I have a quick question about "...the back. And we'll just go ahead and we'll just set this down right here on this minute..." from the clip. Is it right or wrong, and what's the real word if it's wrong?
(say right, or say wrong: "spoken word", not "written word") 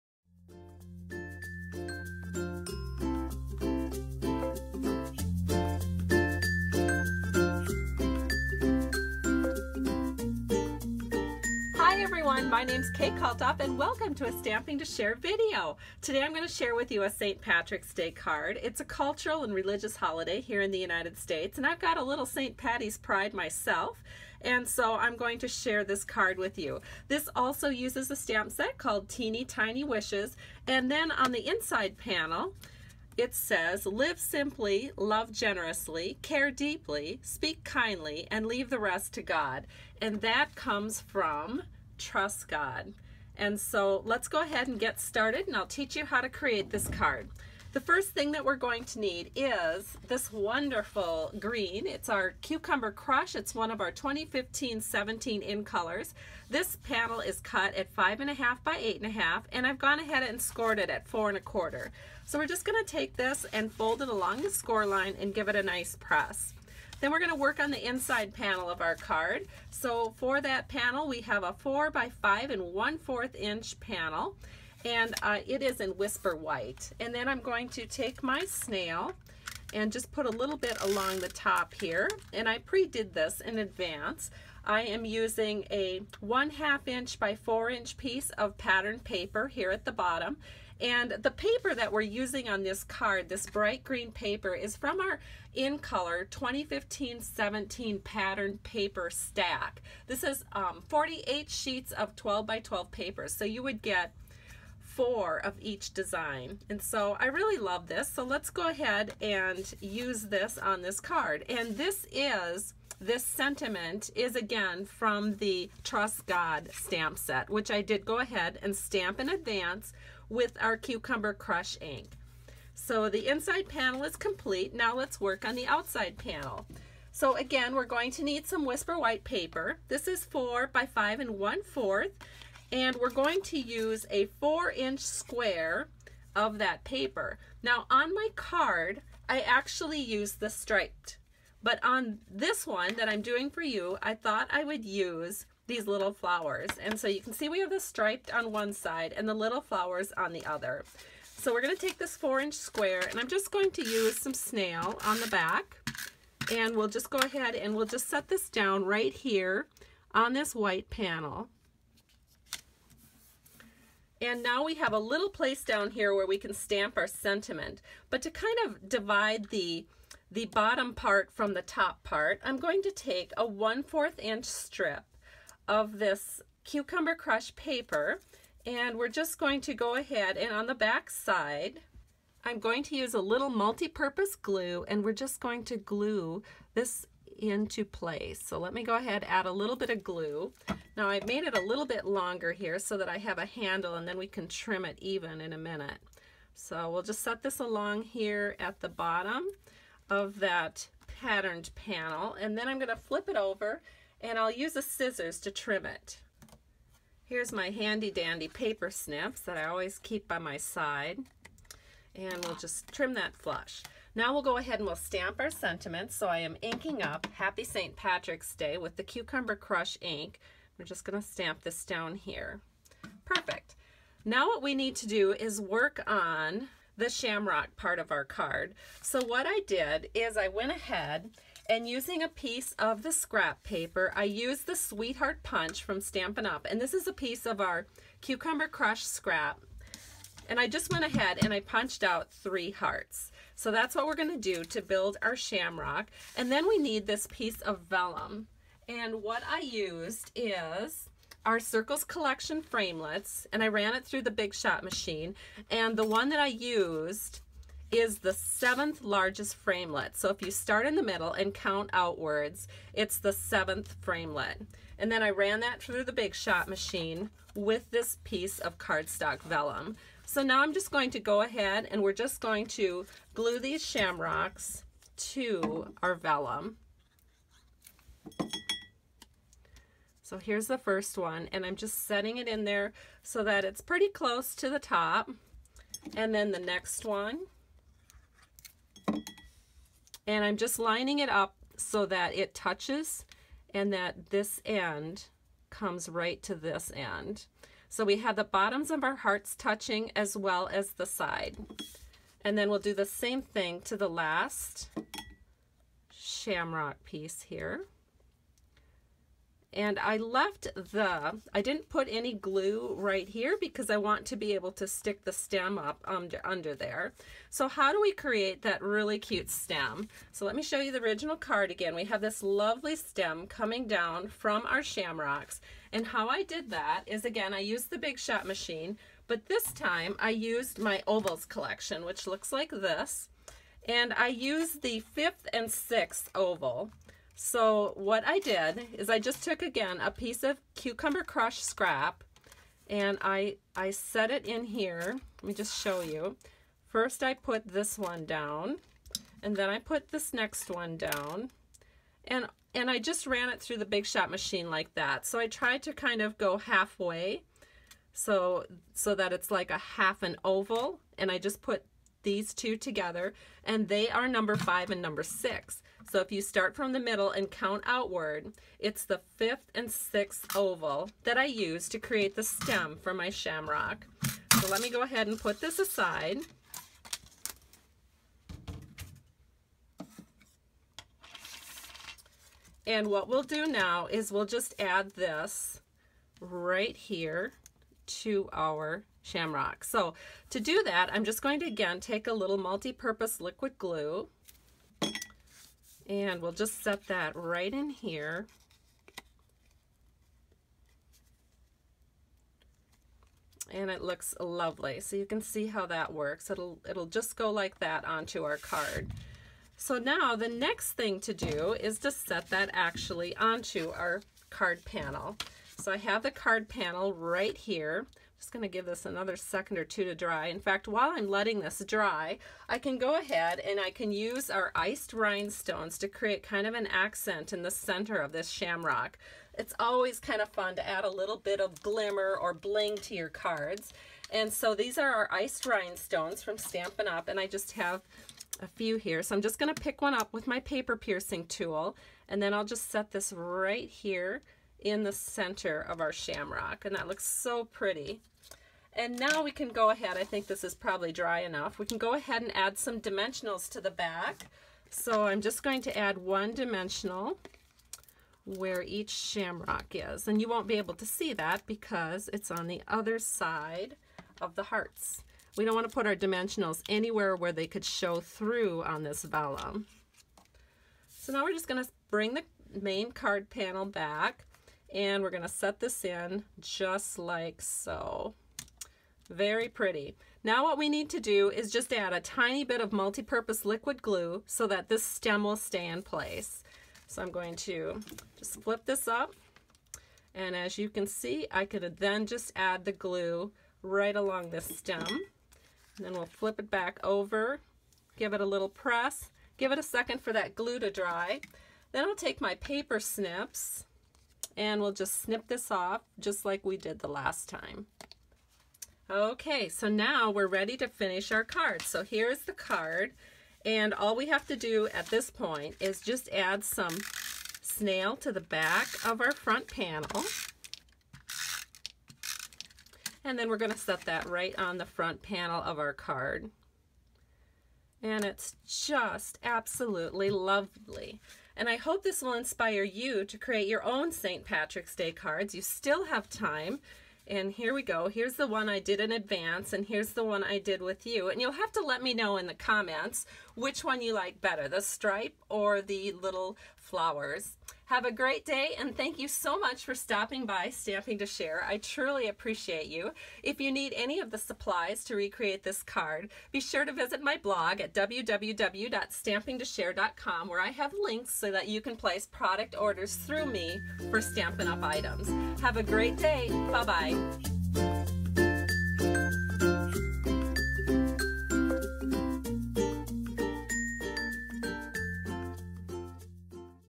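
wrong: "white", not "minute".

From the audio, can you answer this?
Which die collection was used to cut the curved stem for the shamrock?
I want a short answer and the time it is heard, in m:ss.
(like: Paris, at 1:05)
Ovals collection, at 5:31.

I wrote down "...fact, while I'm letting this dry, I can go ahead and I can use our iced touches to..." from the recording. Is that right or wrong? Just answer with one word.
wrong.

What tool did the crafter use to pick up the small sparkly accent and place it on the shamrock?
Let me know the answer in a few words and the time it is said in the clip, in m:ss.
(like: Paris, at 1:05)
Paper piercing tool, at 7:20.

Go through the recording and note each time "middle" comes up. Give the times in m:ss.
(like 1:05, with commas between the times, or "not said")
4:21, 6:06.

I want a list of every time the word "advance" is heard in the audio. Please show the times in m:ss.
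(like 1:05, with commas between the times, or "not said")
1:23, 1:59, 8:59.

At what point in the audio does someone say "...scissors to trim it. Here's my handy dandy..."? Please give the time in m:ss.
3:24.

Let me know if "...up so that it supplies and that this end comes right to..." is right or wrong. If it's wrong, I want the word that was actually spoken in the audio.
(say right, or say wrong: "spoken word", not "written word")
wrong: "touches", not "supplies".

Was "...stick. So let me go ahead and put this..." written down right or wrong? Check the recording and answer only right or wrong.
wrong.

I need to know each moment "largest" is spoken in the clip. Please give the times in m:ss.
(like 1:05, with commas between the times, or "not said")
4:19.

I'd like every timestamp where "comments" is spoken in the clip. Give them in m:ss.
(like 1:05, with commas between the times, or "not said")
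9:02.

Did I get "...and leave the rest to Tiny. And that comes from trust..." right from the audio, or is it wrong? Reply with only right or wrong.
wrong.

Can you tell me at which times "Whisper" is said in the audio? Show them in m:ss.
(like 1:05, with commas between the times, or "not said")
1:15, 2:08.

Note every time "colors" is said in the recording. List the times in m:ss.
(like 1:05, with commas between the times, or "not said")
0:55, 1:35.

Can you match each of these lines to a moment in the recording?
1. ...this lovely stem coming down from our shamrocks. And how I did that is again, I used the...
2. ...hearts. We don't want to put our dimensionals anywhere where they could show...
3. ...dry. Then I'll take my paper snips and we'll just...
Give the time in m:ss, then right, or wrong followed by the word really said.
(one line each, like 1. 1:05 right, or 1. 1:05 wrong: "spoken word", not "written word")
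1. 5:22 right
2. 7:44 right
3. 8:20 right.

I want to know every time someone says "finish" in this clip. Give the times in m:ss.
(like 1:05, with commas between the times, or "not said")
8:30.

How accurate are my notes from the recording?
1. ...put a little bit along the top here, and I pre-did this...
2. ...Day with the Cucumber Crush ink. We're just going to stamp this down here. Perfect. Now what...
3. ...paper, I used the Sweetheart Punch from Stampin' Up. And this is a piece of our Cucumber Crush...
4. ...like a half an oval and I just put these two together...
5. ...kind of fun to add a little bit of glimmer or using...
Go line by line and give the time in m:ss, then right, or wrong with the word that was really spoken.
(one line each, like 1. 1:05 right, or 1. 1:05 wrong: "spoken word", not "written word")
1. 1:20 right
2. 3:38 right
3. 3:53 right
4. 5:59 right
5. 7:10 wrong: "bling", not "using".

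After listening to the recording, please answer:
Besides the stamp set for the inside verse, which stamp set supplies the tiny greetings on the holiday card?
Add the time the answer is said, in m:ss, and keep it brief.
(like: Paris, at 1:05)
Teeny Tiny Wishes, at 0:29.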